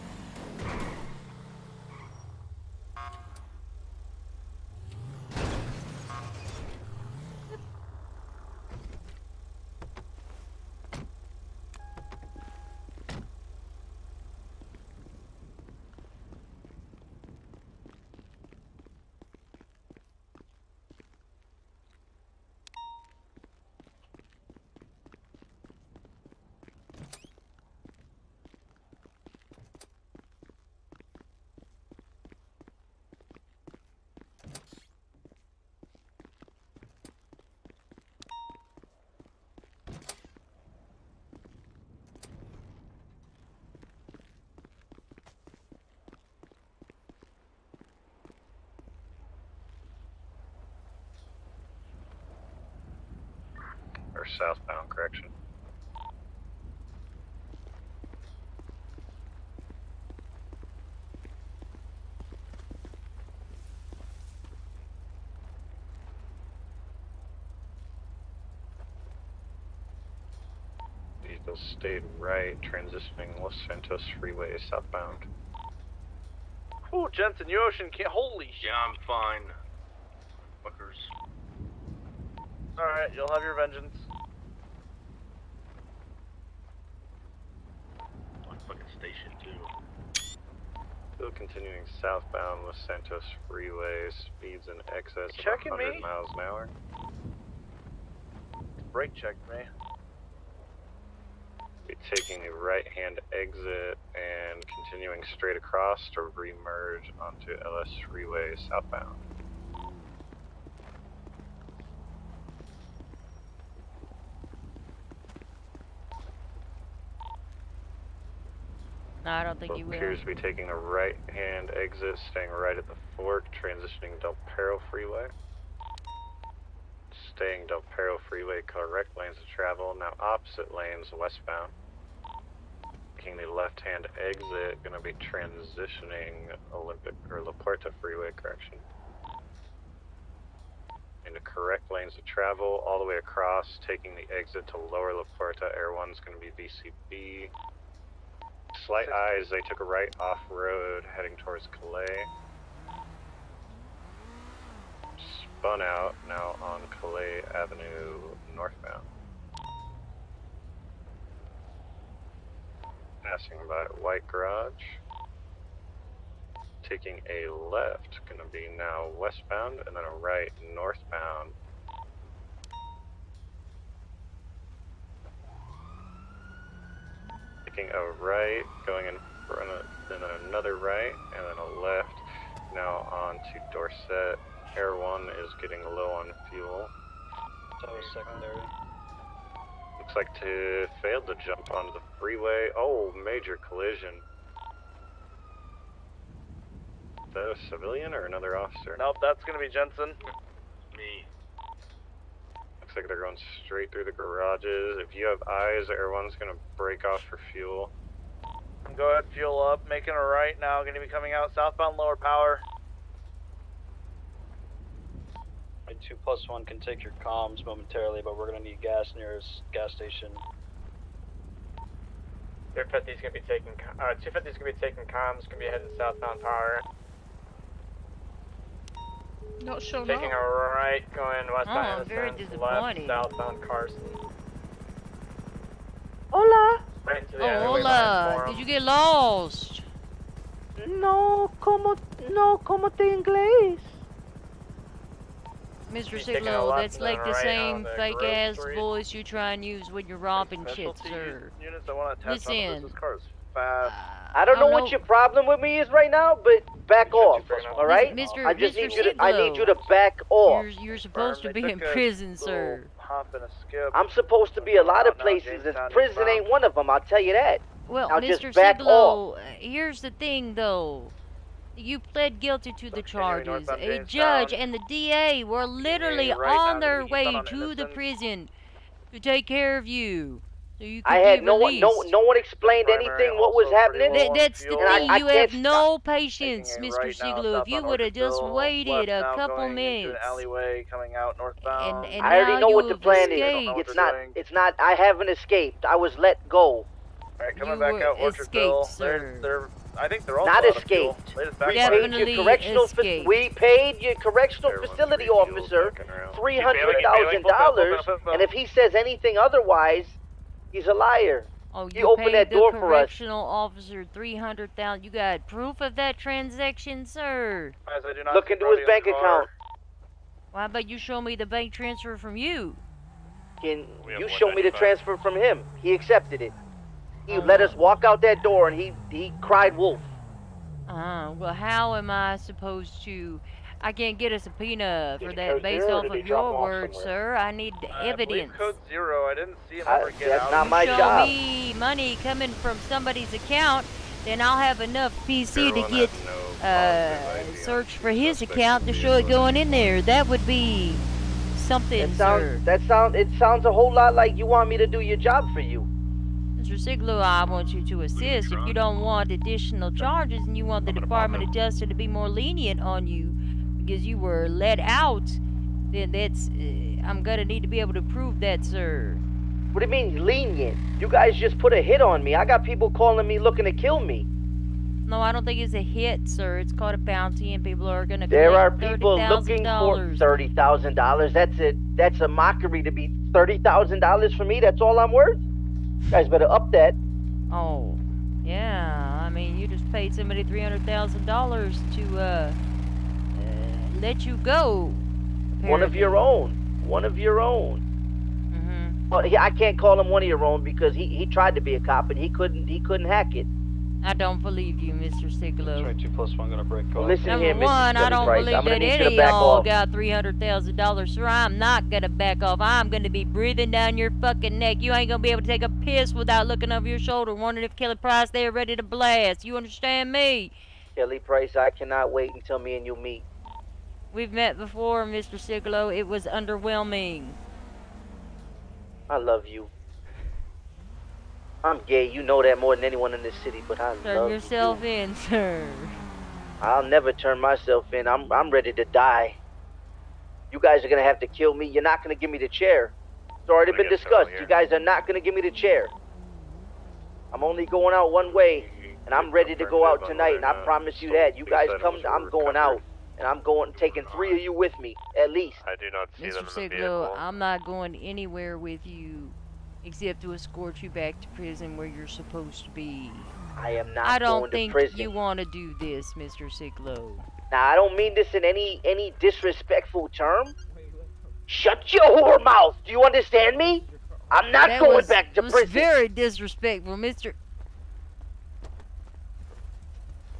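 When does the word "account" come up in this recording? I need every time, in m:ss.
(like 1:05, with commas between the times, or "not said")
5:19, 5:43, 5:48.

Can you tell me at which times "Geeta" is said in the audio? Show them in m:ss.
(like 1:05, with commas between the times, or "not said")
not said.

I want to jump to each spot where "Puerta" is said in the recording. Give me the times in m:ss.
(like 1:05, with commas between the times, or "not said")
2:17, 2:25.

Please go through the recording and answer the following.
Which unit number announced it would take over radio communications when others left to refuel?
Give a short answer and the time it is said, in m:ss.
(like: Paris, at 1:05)
250, at 3:44.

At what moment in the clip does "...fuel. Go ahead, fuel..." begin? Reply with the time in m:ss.
3:27.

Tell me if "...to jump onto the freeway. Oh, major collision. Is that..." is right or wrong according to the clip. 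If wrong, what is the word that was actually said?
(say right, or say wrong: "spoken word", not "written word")
right.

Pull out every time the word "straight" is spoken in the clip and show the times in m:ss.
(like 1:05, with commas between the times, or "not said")
1:45, 3:23.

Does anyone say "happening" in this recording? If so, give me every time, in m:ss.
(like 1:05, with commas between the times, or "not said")
4:43.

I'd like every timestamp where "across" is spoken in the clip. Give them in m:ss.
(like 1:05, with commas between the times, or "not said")
1:45, 2:23.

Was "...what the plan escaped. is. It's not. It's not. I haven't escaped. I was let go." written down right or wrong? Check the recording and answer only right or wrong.
right.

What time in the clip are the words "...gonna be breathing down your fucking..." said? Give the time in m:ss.
6:52.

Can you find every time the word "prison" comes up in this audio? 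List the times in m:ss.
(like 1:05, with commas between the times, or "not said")
4:21, 4:25, 4:37, 7:41, 7:55.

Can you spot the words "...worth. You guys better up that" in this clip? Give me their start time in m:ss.
6:25.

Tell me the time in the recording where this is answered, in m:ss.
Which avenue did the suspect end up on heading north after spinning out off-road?
2:37.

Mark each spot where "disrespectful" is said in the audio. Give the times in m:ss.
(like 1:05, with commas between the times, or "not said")
7:49, 7:56.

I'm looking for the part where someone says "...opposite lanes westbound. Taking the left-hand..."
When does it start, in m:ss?
2:10.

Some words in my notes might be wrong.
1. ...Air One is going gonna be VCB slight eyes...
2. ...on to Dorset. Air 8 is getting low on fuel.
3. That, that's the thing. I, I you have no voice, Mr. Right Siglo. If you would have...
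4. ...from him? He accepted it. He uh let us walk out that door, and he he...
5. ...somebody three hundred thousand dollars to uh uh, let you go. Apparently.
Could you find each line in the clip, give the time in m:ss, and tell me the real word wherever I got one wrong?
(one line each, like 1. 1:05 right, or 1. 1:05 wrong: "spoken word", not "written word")
1. 2:25 right
2. 3:03 wrong: "1", not "8"
3. 4:44 wrong: "patience", not "voice"
4. 5:25 right
5. 6:30 right.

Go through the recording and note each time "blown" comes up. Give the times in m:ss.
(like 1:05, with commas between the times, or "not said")
not said.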